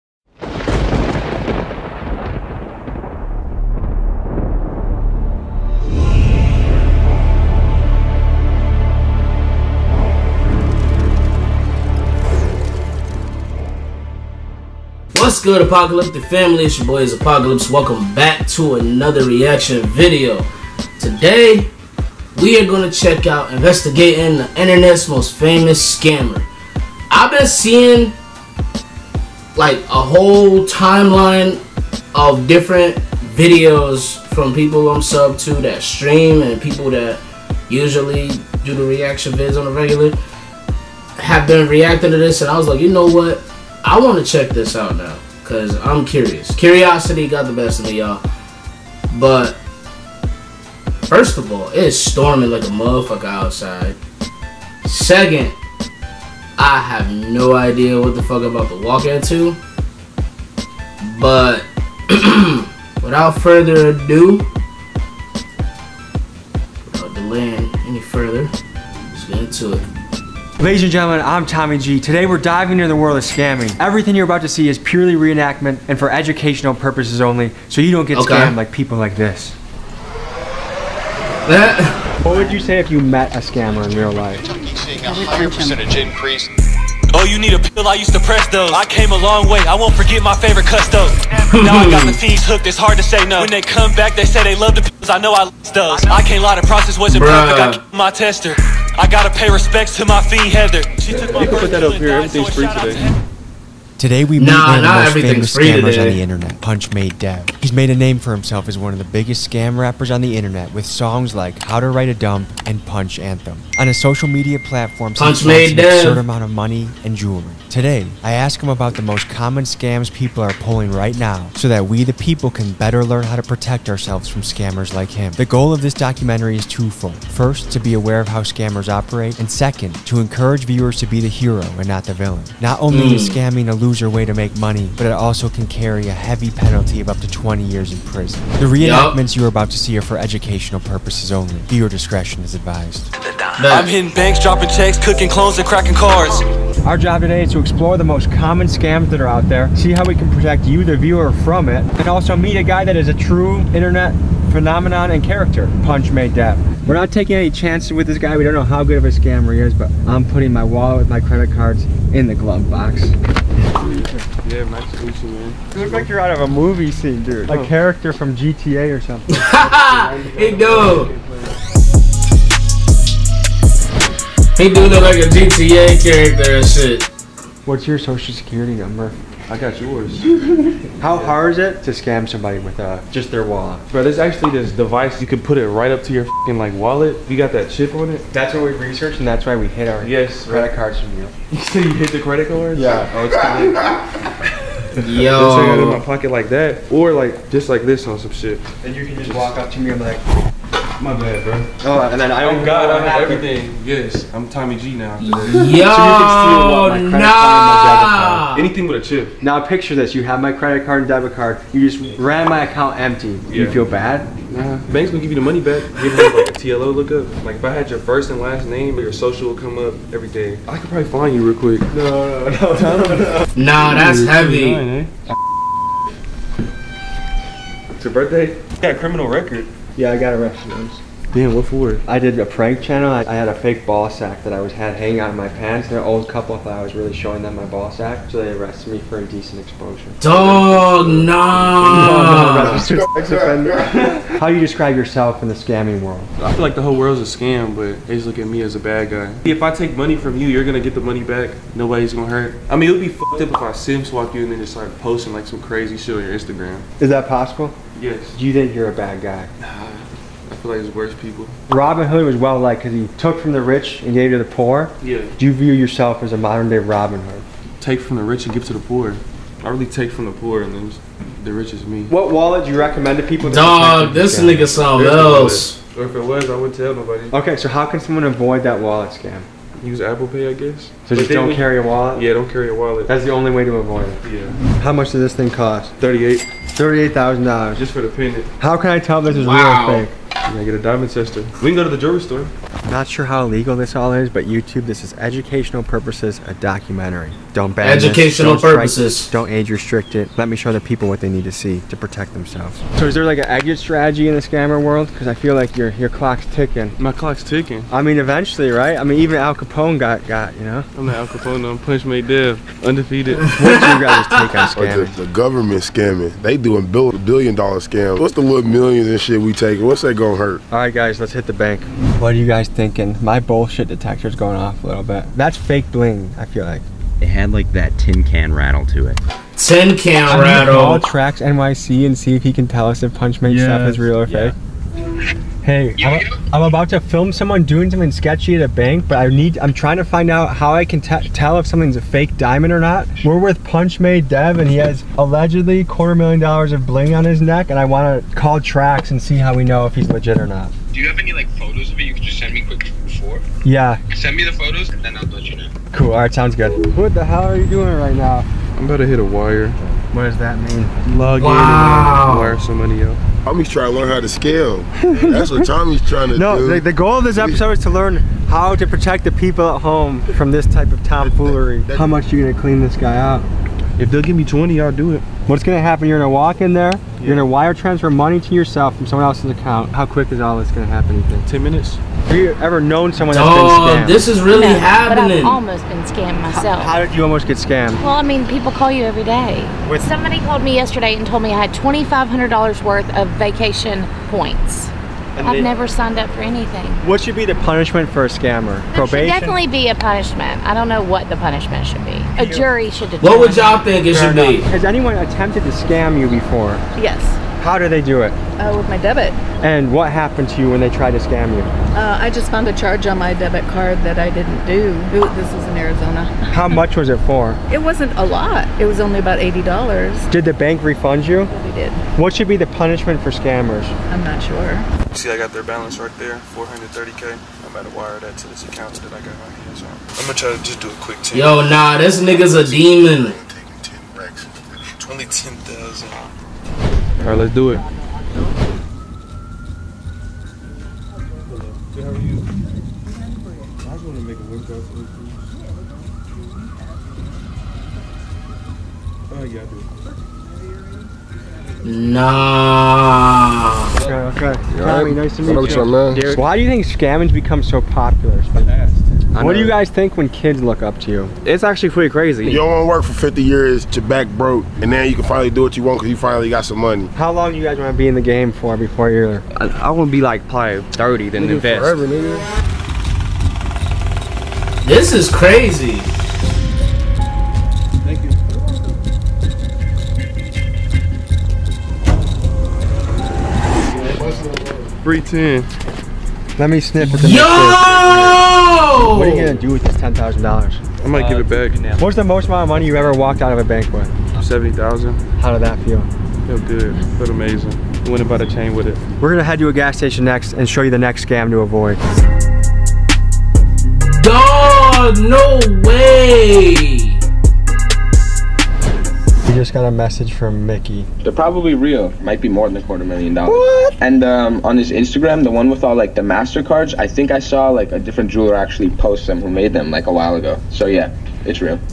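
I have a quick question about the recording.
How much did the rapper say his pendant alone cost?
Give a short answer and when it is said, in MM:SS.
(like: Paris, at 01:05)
$38,000, at 04:46.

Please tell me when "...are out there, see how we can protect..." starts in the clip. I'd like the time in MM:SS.
02:29.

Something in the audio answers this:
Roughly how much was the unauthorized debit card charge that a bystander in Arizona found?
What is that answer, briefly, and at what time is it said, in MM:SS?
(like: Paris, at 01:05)
$80, at 06:59.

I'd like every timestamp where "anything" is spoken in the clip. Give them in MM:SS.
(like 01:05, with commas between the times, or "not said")
03:28, 06:36.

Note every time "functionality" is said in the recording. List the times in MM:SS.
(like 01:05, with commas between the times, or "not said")
not said.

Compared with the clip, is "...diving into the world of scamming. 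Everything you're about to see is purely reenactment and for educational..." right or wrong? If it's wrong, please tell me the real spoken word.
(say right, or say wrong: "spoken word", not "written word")
right.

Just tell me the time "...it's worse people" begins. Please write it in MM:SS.
04:20.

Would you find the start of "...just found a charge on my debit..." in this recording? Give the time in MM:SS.
06:52.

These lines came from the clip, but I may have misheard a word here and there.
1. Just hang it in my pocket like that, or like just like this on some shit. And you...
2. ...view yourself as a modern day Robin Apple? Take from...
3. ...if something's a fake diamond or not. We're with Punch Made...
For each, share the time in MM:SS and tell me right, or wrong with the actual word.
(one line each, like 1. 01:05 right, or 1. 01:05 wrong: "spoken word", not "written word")
1. 03:15 right
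2. 04:25 wrong: "Hood", not "Apple"
3. 05:41 right.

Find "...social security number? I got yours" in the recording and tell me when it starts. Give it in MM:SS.
02:57.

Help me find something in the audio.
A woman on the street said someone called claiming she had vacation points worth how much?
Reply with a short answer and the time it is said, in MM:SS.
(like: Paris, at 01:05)
$2,500, at 06:31.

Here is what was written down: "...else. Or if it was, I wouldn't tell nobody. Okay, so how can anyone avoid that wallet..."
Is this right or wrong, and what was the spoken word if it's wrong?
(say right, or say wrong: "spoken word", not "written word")
wrong: "someone", not "anyone".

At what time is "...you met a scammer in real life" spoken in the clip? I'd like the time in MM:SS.
01:22.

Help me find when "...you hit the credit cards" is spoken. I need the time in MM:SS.
03:11.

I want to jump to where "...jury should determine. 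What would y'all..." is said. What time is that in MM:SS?
06:42.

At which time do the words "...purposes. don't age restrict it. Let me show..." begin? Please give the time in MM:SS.
04:58.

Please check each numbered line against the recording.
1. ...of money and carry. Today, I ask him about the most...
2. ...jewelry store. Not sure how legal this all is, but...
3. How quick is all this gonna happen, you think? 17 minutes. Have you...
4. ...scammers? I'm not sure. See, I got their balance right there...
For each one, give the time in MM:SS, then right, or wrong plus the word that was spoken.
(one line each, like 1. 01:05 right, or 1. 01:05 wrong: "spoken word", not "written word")
1. 01:56 wrong: "jewelry", not "carry"
2. 04:51 right
3. 06:19 wrong: "10", not "17"
4. 07:03 right.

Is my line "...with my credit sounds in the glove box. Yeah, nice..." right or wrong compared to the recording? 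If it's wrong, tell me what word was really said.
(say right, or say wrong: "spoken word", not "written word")
wrong: "cards", not "sounds".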